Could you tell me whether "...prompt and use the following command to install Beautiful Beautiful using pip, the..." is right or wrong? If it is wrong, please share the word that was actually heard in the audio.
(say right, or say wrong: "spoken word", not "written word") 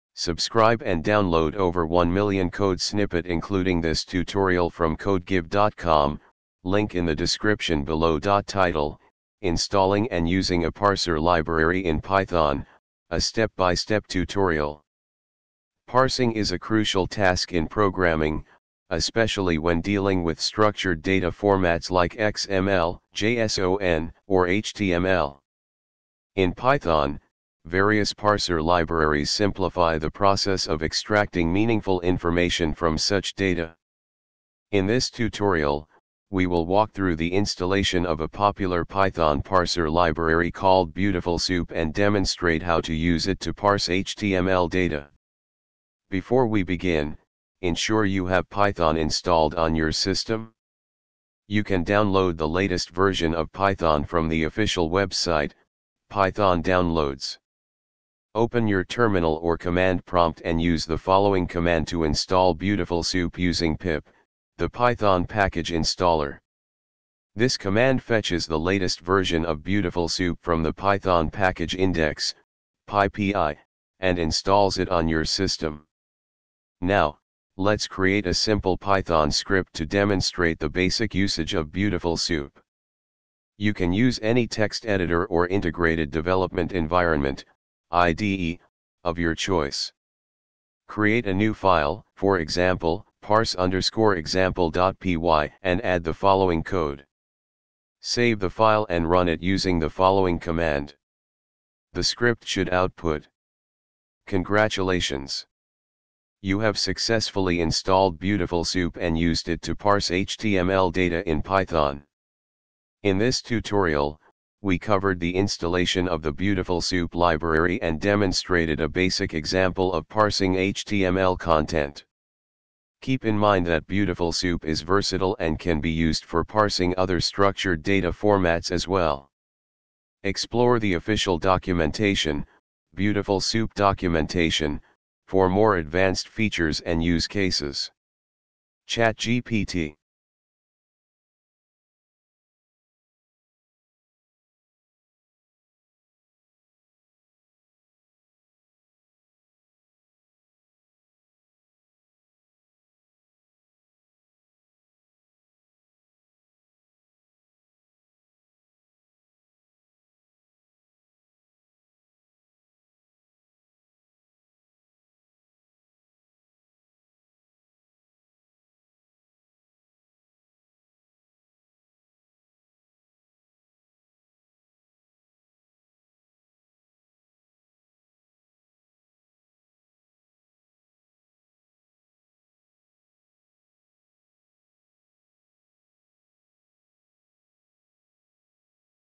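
wrong: "Soup", not "Beautiful".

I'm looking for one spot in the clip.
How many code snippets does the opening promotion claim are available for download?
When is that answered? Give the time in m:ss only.
0:01.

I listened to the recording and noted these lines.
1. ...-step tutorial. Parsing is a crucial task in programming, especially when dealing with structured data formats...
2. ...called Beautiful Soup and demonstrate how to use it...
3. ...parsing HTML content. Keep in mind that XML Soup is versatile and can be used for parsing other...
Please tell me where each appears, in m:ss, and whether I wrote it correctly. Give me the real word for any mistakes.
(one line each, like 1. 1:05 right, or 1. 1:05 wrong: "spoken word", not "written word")
1. 0:14 right
2. 0:40 right
3. 2:00 wrong: "Beautiful", not "XML".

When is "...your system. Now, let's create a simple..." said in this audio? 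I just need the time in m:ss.
1:15.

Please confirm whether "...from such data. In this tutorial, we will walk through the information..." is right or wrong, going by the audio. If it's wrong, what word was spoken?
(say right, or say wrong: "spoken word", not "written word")
wrong: "installation", not "information".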